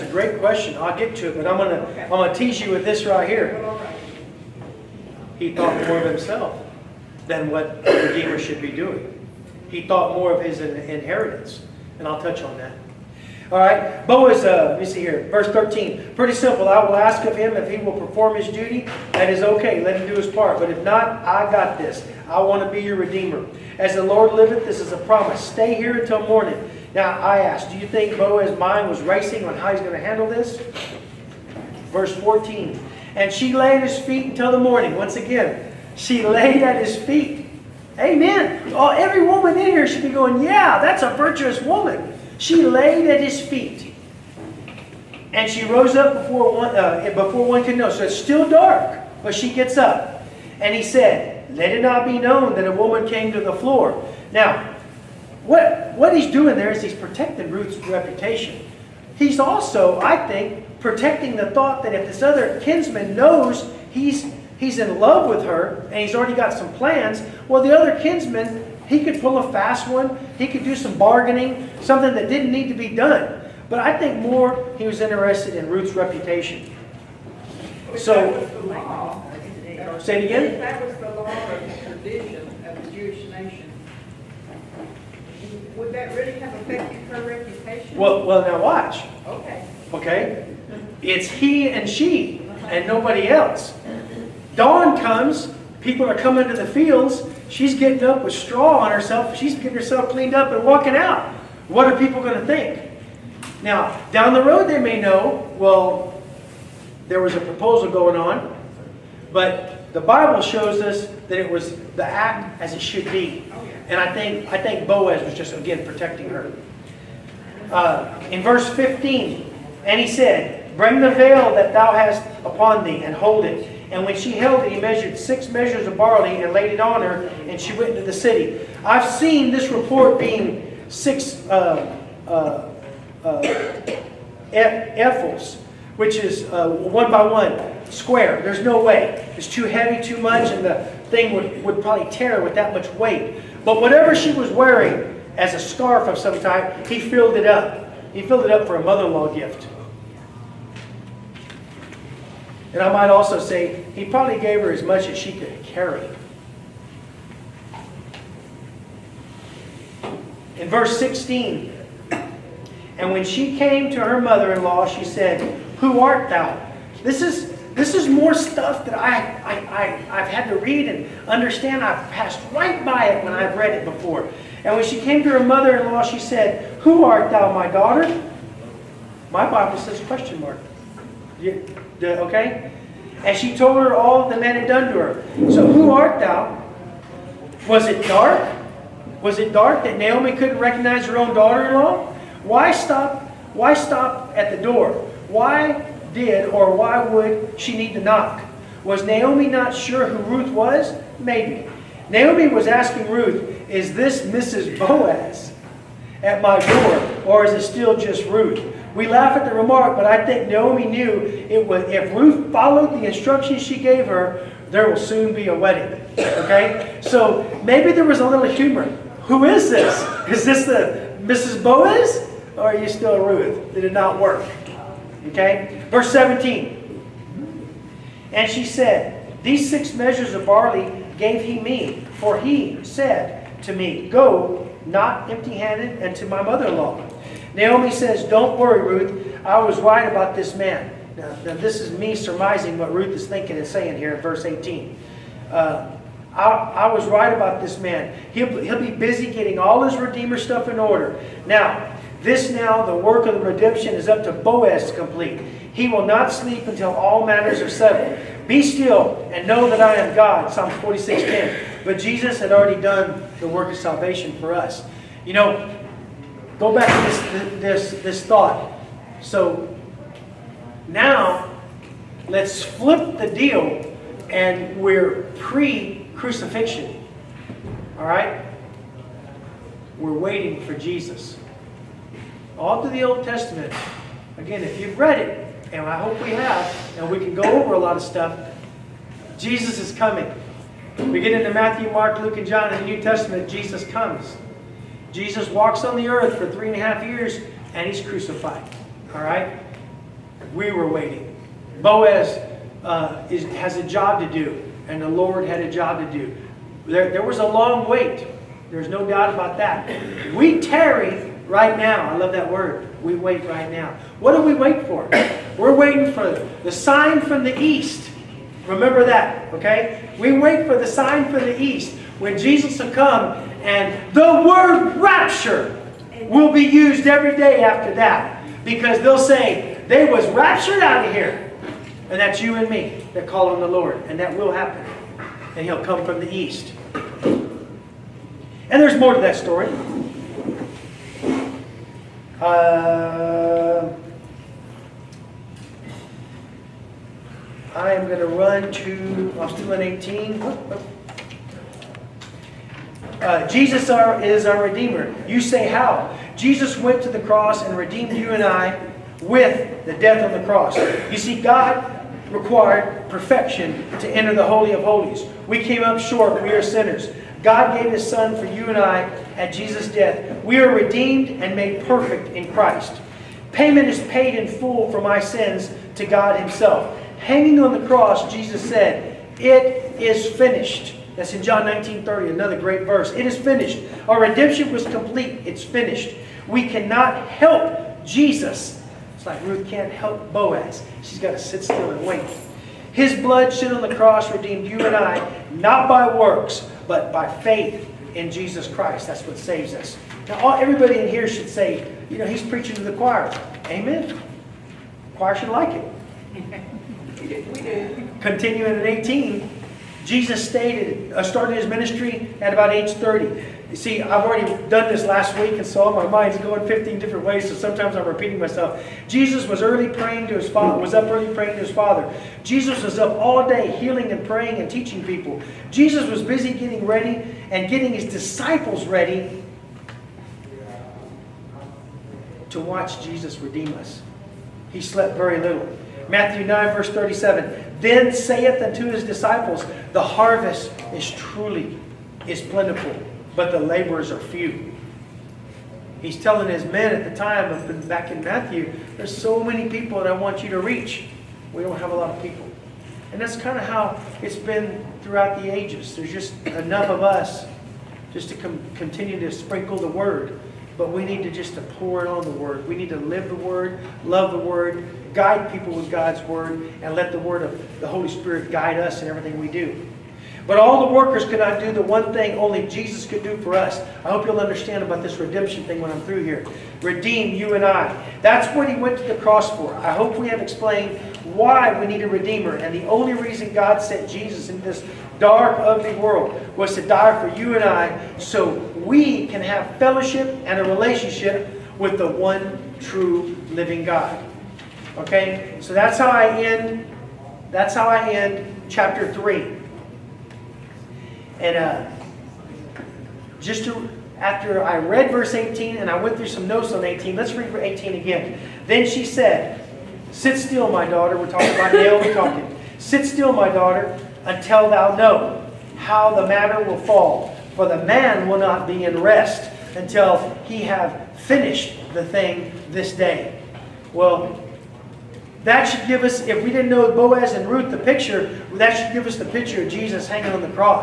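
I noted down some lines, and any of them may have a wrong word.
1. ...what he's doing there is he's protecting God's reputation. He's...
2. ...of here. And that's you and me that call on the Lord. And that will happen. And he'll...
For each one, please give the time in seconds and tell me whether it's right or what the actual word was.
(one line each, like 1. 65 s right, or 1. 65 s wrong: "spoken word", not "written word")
1. 55 s wrong: "Ruth", not "God"
2. 331 s right.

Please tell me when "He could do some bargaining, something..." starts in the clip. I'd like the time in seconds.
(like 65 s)
70 s.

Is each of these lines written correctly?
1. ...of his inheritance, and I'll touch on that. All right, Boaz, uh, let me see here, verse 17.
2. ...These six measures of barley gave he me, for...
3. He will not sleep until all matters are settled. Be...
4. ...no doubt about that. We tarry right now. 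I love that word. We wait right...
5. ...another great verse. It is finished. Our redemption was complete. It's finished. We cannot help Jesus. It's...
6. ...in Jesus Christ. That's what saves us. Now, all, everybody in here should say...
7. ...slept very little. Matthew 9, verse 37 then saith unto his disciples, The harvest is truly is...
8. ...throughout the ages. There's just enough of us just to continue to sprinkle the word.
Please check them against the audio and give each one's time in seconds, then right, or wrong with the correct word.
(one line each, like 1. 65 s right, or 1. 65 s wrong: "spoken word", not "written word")
1. 10 s wrong: "13", not "17"
2. 229 s right
3. 255 s right
4. 308 s right
5. 382 s right
6. 398 s right
7. 434 s right
8. 455 s right.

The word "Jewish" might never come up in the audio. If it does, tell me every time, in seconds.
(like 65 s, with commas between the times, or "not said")
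82 s.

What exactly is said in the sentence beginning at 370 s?
We are redeemed and made perfect in Christ.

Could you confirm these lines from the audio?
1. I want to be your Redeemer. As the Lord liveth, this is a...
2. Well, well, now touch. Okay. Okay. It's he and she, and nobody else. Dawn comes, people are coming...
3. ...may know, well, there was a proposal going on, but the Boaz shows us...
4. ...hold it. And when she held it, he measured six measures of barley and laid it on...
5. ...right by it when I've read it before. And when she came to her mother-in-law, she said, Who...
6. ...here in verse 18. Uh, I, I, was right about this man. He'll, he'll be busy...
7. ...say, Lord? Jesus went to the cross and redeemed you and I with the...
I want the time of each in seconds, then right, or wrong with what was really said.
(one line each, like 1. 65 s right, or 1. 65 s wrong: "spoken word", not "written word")
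1. 22 s right
2. 87 s wrong: "watch", not "touch"
3. 104 s wrong: "Bible", not "Boaz"
4. 123 s right
5. 172 s right
6. 243 s right
7. 355 s wrong: "How", not "Lord".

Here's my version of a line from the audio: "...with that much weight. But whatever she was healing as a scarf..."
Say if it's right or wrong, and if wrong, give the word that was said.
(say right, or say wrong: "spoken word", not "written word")
wrong: "wearing", not "healing".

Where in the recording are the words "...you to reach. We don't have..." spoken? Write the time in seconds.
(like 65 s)
450 s.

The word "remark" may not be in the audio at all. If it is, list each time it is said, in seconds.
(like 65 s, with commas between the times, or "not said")
209 s.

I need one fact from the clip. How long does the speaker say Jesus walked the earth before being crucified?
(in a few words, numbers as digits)
3.5 years.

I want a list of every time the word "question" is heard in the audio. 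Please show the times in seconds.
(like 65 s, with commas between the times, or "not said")
0 s, 180 s.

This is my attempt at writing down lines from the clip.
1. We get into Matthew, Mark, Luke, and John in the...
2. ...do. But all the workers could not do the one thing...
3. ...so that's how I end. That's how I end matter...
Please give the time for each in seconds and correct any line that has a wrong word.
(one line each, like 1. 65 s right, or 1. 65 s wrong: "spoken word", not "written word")
1. 291 s right
2. 469 s right
3. 495 s wrong: "chapter", not "matter".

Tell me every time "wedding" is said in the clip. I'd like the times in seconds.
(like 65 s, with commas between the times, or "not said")
215 s.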